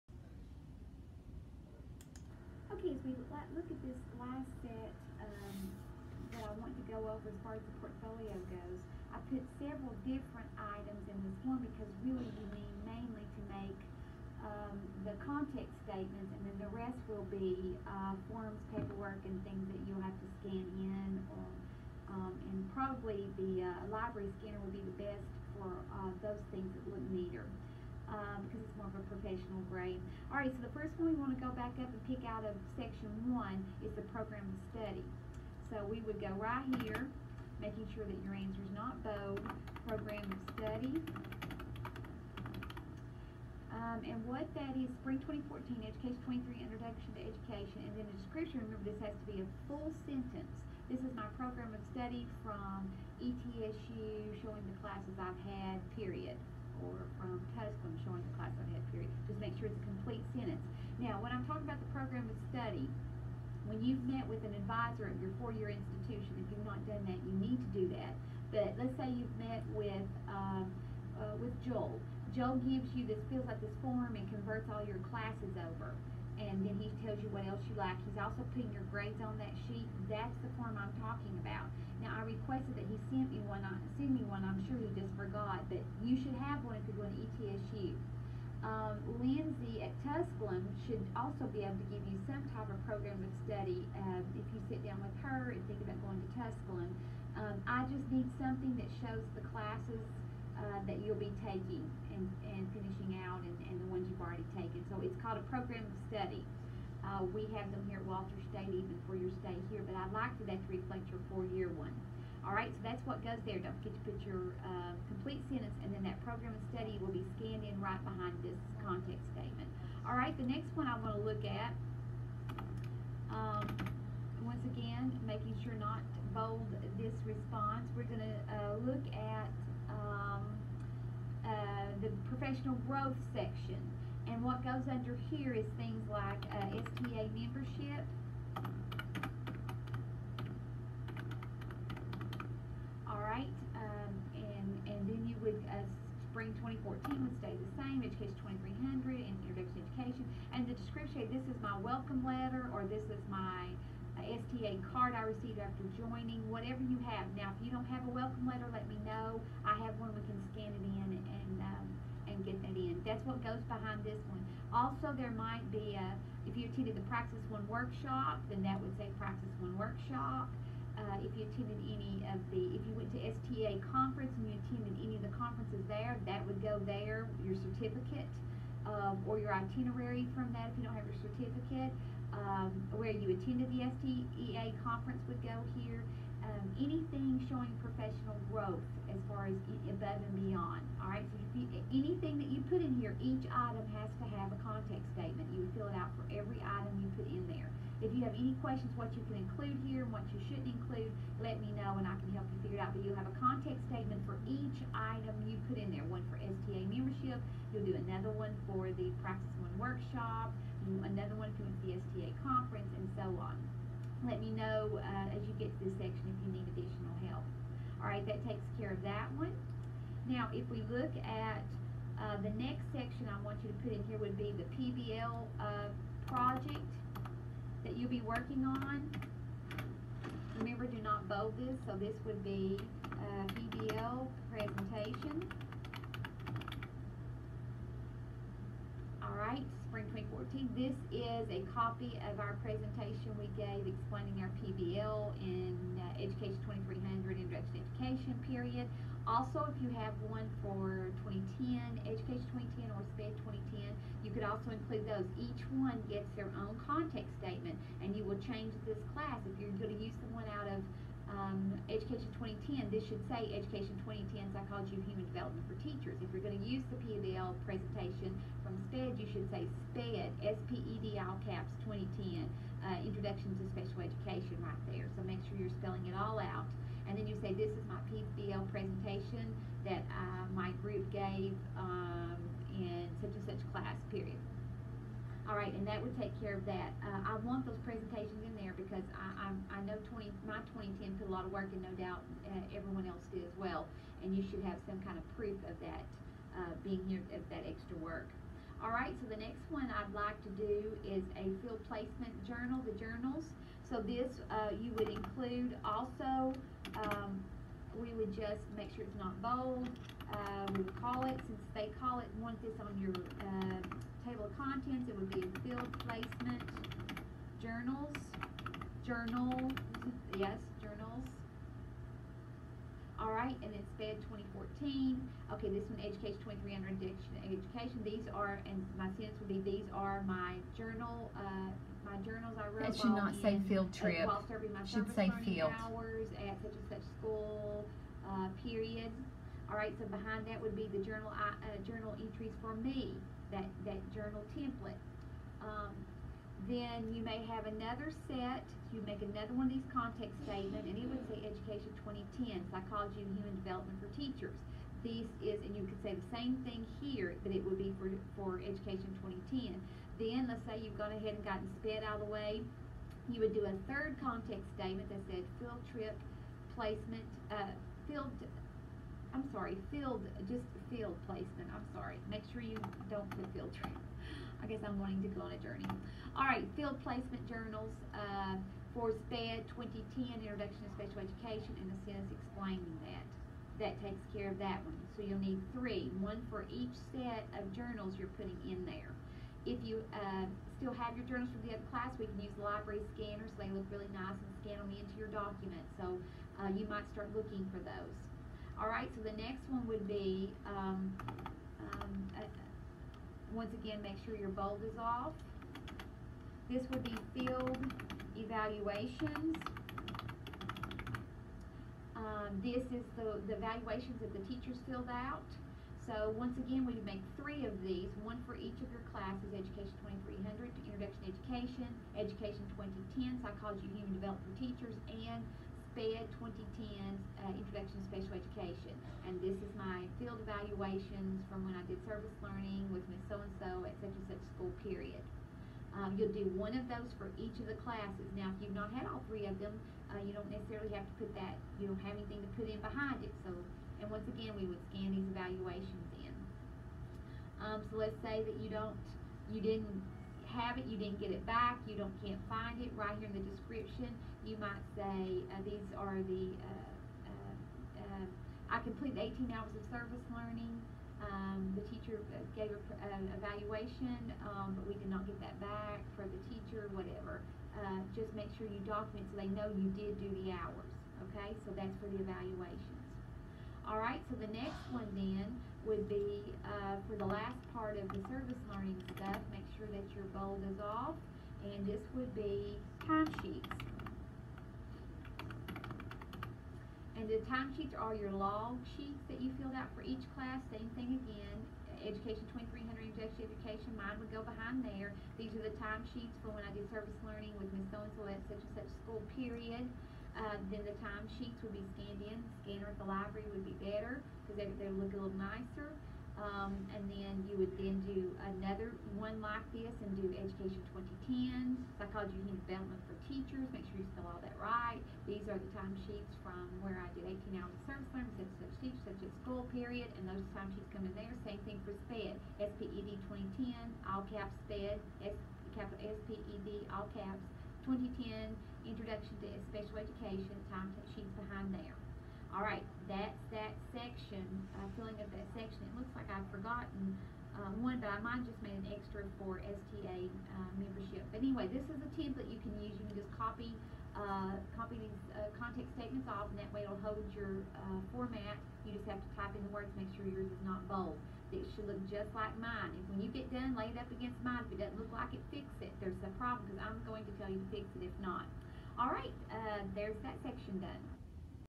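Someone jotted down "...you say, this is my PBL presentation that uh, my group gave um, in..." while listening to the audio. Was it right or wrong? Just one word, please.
right.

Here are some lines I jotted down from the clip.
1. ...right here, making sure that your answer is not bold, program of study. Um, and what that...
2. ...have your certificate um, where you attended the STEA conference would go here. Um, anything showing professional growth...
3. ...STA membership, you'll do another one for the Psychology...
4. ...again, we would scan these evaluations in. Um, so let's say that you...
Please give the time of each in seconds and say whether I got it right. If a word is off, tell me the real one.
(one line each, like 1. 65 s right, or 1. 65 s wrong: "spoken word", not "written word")
1. 36 s right
2. 180 s right
3. 206 s wrong: "Praxis", not "Psychology"
4. 444 s right.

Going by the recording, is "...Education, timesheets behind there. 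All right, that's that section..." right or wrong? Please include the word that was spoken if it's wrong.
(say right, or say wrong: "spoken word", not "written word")
right.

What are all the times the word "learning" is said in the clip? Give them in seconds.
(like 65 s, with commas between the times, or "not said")
432 s, 460 s, 478 s, 497 s, 518 s.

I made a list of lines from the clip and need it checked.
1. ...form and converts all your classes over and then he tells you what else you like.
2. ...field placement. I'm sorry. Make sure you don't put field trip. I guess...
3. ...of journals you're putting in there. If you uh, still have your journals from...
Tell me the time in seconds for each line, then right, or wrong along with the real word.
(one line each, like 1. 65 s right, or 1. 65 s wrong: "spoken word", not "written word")
1. 73 s right
2. 370 s right
3. 387 s right.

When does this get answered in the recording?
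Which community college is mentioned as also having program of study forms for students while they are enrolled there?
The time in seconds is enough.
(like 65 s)
108 s.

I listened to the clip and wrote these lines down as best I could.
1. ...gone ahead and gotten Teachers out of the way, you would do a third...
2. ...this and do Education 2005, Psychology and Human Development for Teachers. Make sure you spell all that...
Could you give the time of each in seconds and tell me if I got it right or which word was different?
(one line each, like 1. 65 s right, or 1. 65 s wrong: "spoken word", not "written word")
1. 360 s wrong: "SPED", not "Teachers"
2. 509 s wrong: "2010", not "2005".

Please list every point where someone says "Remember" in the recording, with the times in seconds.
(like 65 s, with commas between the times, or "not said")
48 s, 230 s.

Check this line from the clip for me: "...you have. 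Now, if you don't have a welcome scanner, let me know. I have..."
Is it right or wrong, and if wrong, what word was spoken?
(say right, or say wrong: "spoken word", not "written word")
wrong: "letter", not "scanner".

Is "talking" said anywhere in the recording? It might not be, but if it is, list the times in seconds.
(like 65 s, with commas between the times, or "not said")
61 s, 81 s.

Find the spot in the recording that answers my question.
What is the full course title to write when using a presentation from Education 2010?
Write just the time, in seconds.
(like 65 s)
264 s.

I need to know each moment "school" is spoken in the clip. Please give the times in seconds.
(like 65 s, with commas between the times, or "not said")
337 s, 434 s, 499 s, 519 s.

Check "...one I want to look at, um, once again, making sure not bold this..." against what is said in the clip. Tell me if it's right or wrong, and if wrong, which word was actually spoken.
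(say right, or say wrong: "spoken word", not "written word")
right.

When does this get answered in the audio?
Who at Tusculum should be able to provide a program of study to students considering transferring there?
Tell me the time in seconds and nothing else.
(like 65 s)
89 s.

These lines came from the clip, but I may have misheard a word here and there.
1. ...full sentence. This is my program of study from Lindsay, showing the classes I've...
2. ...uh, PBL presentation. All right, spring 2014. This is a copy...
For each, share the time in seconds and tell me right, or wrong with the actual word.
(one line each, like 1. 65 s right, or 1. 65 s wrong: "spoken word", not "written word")
1. 49 s wrong: "ETSU", not "Lindsay"
2. 233 s right.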